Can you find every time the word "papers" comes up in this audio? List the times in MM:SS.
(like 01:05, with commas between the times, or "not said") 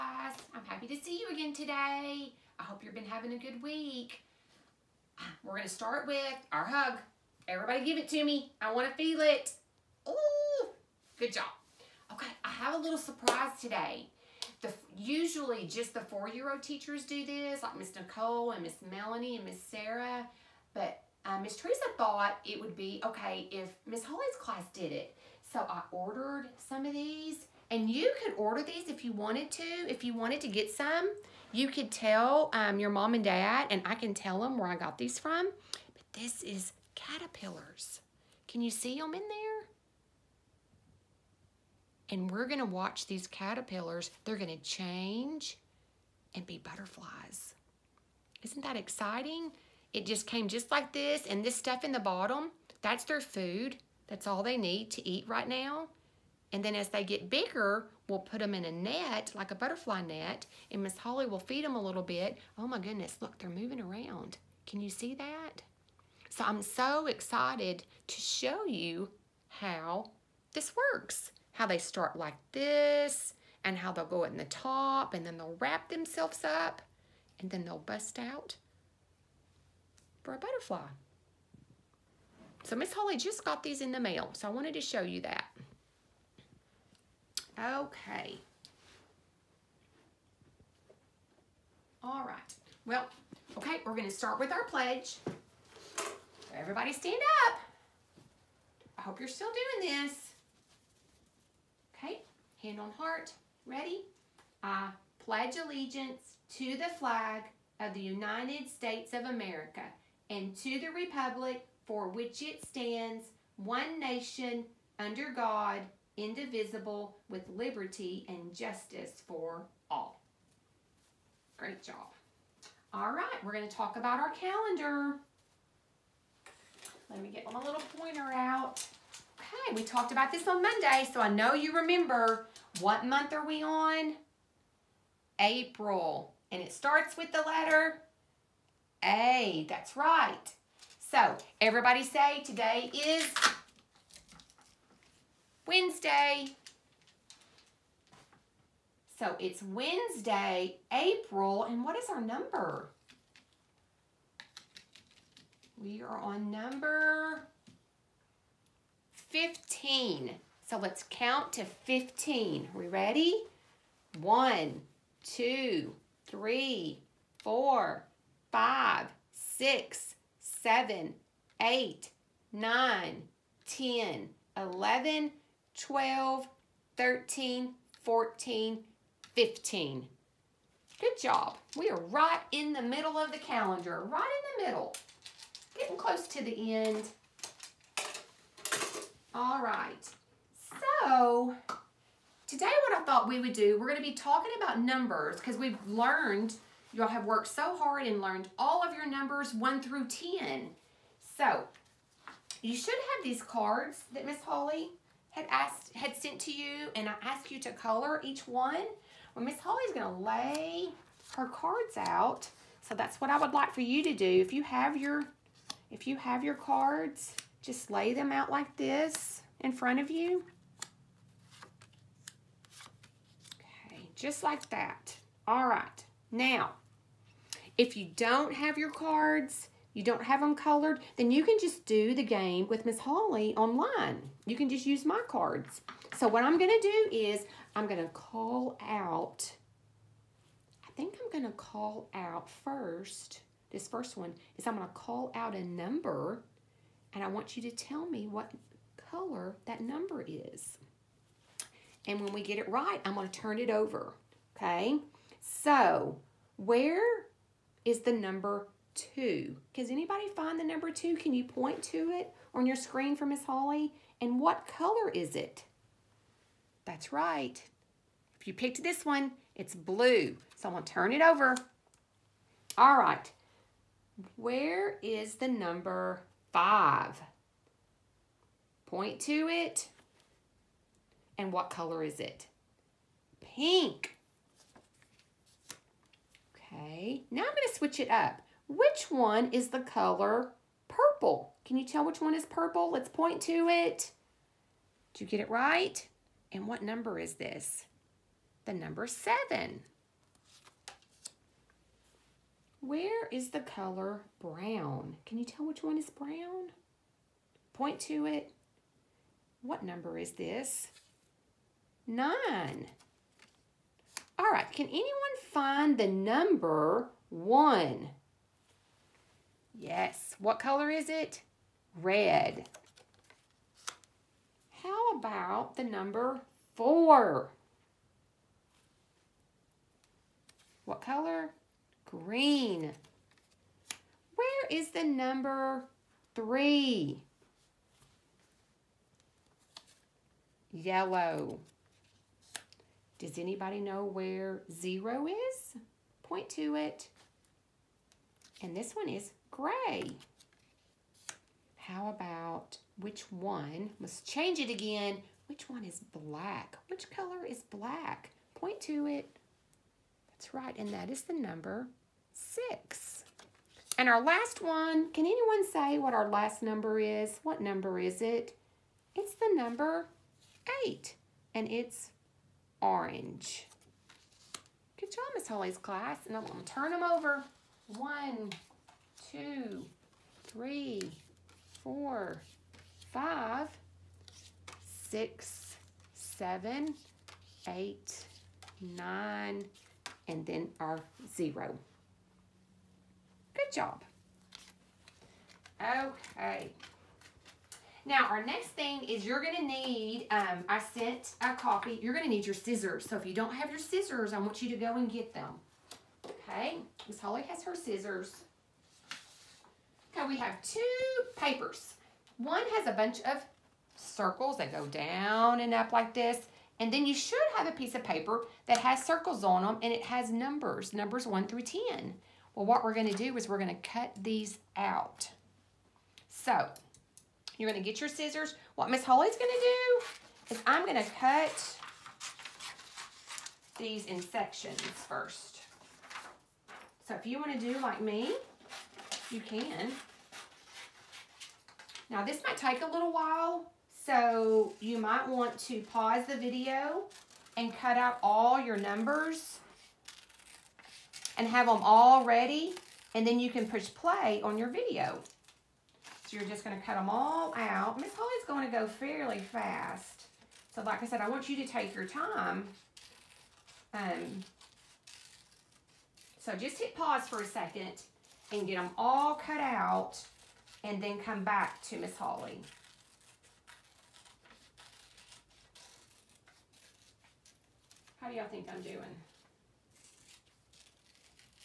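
06:51, 06:58.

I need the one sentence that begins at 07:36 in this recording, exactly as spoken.
So you're just gonna cut them all out.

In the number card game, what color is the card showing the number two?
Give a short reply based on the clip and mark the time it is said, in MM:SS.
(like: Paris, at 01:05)
blue, at 04:29.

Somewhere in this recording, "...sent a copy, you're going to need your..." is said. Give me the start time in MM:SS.
06:40.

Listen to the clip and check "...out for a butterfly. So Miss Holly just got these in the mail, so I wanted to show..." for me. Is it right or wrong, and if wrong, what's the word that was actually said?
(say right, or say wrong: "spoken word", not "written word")
right.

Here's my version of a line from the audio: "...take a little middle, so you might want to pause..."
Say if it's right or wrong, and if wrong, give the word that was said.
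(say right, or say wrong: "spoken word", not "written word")
wrong: "while", not "middle".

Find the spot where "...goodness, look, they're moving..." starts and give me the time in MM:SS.
01:02.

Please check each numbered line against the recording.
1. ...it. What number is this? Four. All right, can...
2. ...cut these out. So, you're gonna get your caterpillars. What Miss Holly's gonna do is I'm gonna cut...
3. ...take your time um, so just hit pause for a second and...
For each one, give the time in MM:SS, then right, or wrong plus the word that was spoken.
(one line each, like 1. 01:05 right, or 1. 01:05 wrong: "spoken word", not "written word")
1. 05:08 wrong: "Nine", not "Four"
2. 07:03 wrong: "scissors", not "caterpillars"
3. 07:41 right.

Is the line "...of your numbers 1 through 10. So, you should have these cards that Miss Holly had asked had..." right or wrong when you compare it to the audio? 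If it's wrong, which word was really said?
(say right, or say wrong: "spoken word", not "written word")
right.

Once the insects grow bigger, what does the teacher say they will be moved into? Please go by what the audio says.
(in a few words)
butterfly net.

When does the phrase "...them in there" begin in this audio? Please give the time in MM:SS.
00:38.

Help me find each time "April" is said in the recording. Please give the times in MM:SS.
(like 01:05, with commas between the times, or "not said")
02:15, 02:30.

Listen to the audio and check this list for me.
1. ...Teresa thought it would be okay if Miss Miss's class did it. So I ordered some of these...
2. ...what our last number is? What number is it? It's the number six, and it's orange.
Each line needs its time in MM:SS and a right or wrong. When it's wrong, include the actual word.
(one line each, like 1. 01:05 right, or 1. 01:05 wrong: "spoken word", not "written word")
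1. 00:21 wrong: "Holly", not "Miss"
2. 06:05 wrong: "eight", not "six".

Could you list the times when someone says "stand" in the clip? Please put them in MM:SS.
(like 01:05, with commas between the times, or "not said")
01:36, 01:52.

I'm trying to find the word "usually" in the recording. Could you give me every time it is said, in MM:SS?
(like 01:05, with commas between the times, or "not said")
00:14.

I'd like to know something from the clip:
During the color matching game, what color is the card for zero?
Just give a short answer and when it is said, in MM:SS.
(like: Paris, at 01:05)
gray, at 05:49.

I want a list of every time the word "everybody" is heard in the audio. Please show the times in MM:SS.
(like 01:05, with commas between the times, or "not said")
00:07, 01:36, 02:21.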